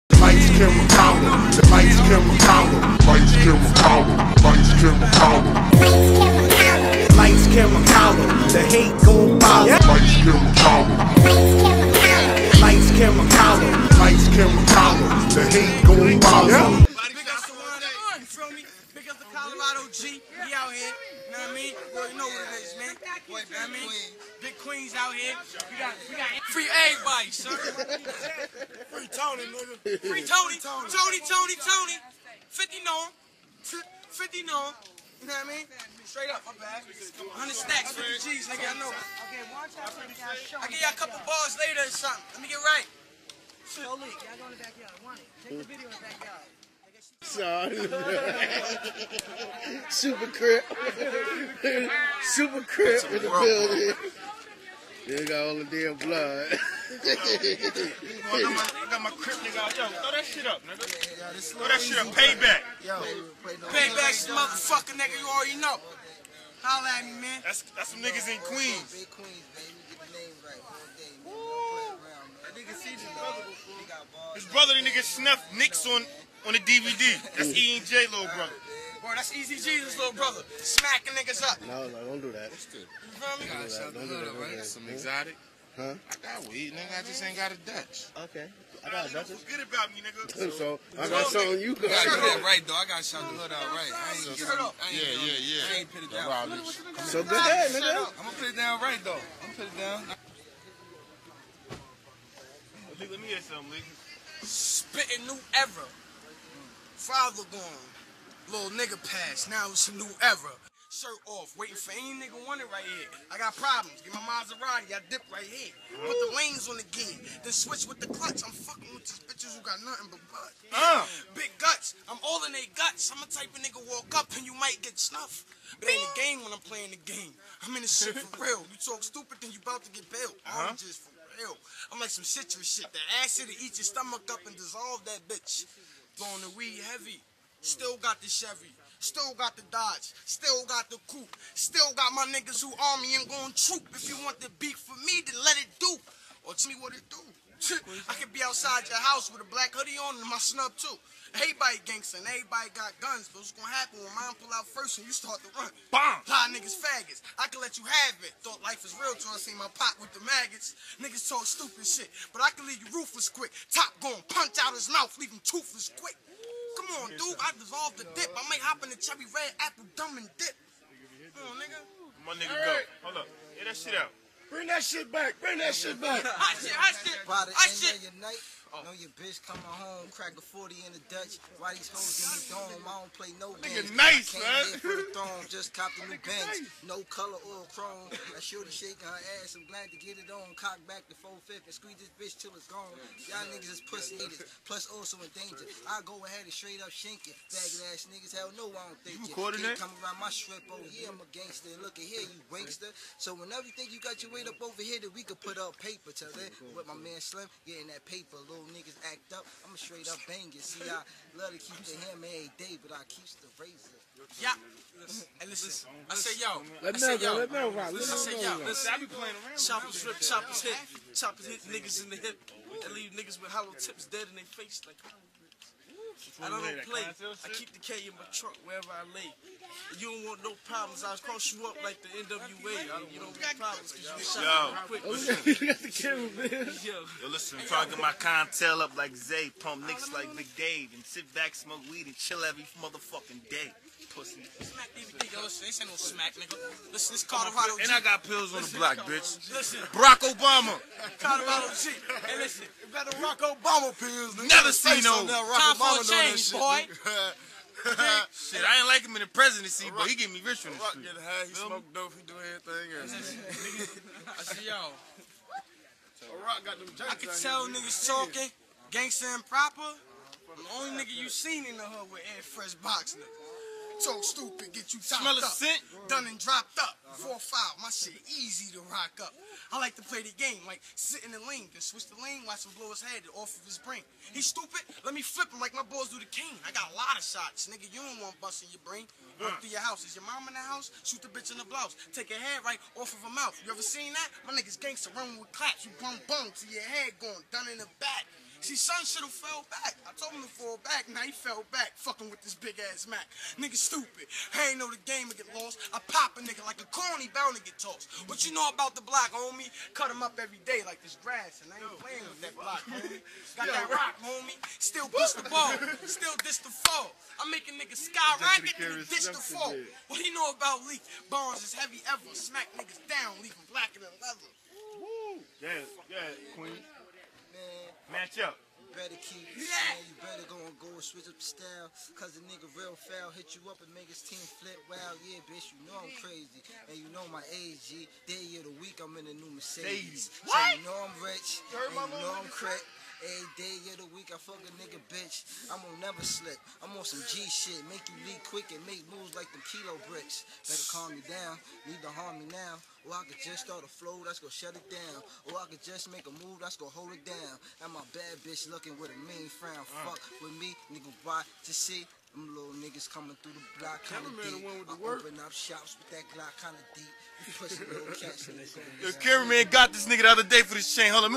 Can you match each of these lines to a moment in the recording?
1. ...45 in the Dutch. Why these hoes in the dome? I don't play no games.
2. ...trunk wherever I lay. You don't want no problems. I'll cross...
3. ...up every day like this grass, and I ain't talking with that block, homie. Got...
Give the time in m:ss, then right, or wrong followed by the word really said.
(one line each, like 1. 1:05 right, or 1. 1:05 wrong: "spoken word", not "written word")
1. 3:00 wrong: "40", not "45"
2. 3:48 right
3. 5:10 wrong: "playing", not "talking".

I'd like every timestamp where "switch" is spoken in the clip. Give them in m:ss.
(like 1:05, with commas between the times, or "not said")
1:57, 4:41, 5:31.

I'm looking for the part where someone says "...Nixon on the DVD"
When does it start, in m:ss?
1:15.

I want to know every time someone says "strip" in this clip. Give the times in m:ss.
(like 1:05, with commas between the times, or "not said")
3:20.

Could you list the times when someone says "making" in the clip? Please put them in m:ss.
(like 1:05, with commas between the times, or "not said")
5:17.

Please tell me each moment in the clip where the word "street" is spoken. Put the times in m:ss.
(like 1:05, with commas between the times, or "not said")
4:20.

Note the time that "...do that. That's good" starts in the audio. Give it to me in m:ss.
1:22.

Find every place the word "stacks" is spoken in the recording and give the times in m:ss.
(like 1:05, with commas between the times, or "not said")
0:37.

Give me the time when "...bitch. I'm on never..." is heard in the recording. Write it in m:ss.
5:45.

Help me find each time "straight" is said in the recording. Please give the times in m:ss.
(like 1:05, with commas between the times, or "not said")
0:36, 3:16, 3:29.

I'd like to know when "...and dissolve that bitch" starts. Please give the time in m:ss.
2:14.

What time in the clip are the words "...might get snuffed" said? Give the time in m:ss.
2:04.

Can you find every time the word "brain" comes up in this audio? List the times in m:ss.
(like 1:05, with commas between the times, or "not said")
4:43, 4:48.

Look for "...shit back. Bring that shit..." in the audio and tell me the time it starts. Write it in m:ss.
2:54.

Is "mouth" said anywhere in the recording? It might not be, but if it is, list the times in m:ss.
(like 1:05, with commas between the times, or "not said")
2:44, 4:53.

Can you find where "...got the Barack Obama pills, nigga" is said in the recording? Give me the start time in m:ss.
4:12.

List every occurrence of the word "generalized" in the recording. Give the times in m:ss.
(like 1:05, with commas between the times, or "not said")
not said.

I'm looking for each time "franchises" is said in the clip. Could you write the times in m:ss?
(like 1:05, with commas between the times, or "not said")
not said.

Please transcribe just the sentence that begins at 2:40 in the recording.
Niggas talk stupid shit, but I can leave you ruthless quick.